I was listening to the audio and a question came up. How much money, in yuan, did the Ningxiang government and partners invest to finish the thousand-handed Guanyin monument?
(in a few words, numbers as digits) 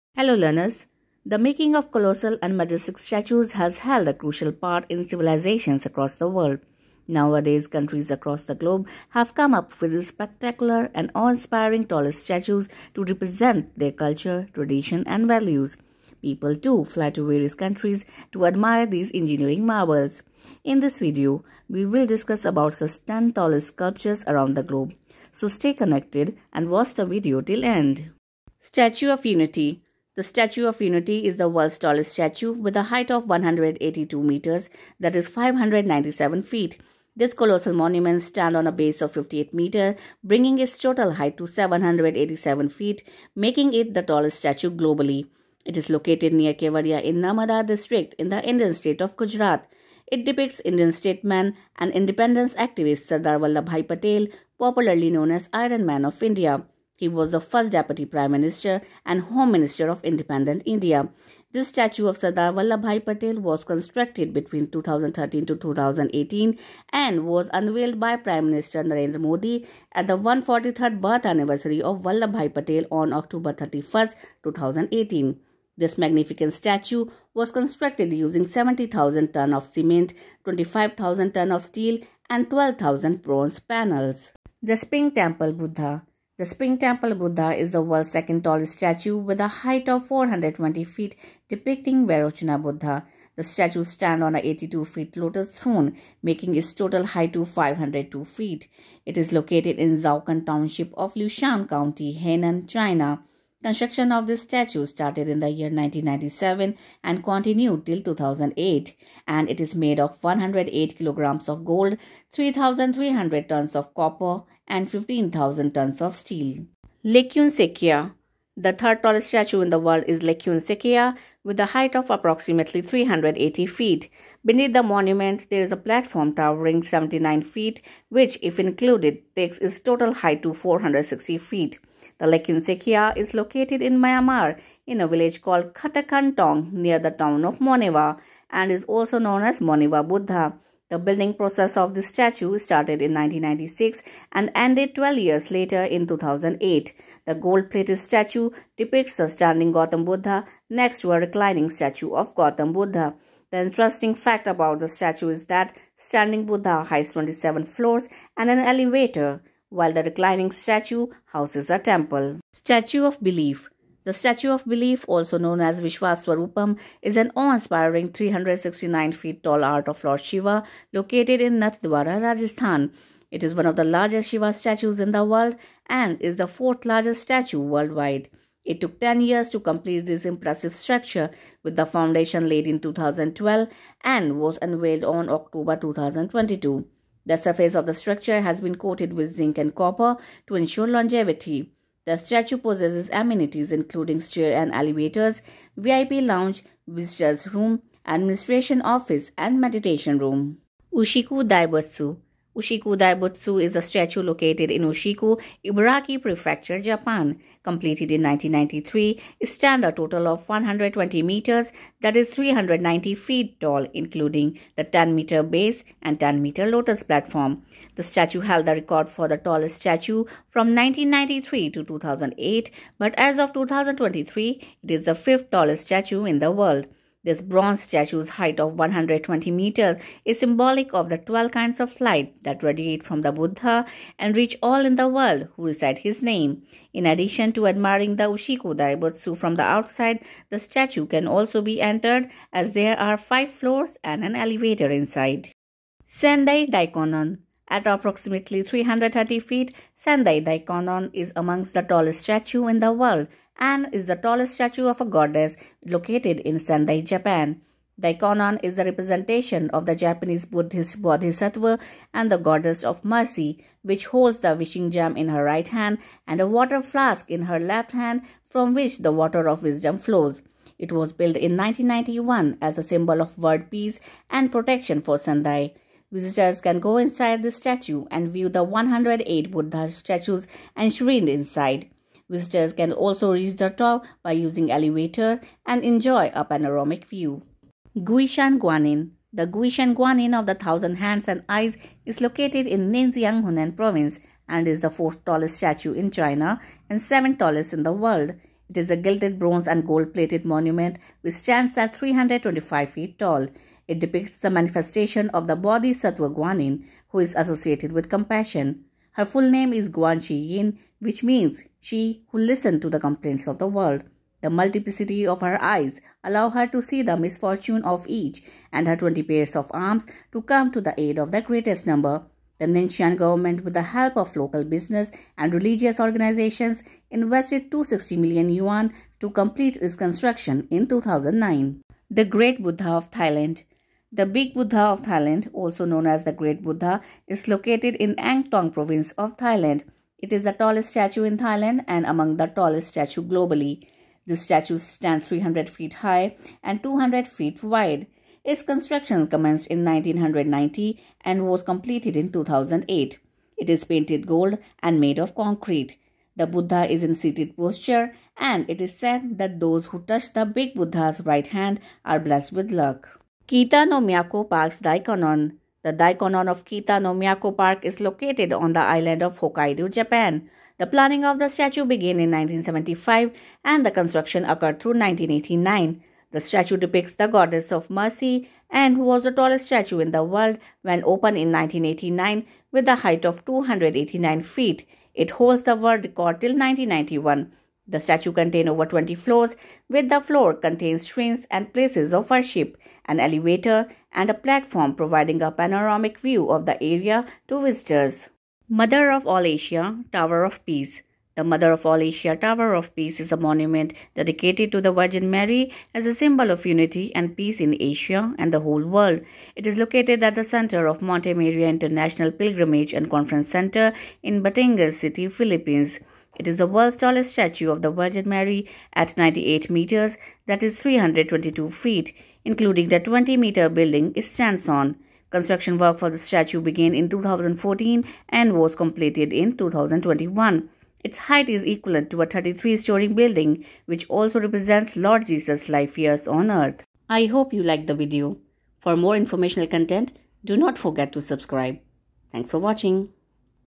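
260 million yuan.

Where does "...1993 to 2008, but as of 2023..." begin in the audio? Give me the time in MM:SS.
03:40.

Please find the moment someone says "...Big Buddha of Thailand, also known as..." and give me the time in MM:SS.
05:34.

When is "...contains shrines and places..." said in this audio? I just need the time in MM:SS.
06:30.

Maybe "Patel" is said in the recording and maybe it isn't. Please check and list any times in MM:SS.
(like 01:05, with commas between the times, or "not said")
00:53, 01:03, 01:12.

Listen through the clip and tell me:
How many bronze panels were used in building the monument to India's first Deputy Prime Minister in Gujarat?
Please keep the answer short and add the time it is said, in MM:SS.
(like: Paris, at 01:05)
12,000, at 01:22.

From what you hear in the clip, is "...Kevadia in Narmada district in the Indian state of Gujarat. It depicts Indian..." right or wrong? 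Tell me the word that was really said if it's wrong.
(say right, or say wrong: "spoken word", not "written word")
right.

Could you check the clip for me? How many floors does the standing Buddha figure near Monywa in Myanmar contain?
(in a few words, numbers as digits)
27.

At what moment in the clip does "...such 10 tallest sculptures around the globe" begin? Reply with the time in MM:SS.
00:22.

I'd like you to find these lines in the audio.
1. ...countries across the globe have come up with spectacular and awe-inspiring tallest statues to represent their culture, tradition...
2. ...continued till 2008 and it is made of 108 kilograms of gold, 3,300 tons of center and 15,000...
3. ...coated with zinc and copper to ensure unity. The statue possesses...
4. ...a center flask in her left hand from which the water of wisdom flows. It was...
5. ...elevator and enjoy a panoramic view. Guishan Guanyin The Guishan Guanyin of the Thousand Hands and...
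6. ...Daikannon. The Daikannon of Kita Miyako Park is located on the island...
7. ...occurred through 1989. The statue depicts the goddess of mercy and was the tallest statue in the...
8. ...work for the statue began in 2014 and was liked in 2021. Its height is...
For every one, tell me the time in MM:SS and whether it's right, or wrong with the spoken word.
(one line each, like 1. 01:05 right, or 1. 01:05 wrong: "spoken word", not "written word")
1. 00:07 right
2. 01:47 wrong: "copper", not "center"
3. 03:08 wrong: "longevity", not "unity"
4. 04:26 wrong: "water", not "center"
5. 04:44 right
6. 06:04 right
7. 06:14 right
8. 07:05 wrong: "completed", not "liked".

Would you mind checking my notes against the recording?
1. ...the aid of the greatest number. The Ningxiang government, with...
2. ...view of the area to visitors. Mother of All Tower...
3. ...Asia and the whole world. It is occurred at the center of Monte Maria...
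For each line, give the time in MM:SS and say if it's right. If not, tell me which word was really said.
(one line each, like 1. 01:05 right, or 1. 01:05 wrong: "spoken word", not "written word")
1. 05:20 right
2. 06:36 wrong: "Asia", not "Tower"
3. 06:47 wrong: "located", not "occurred".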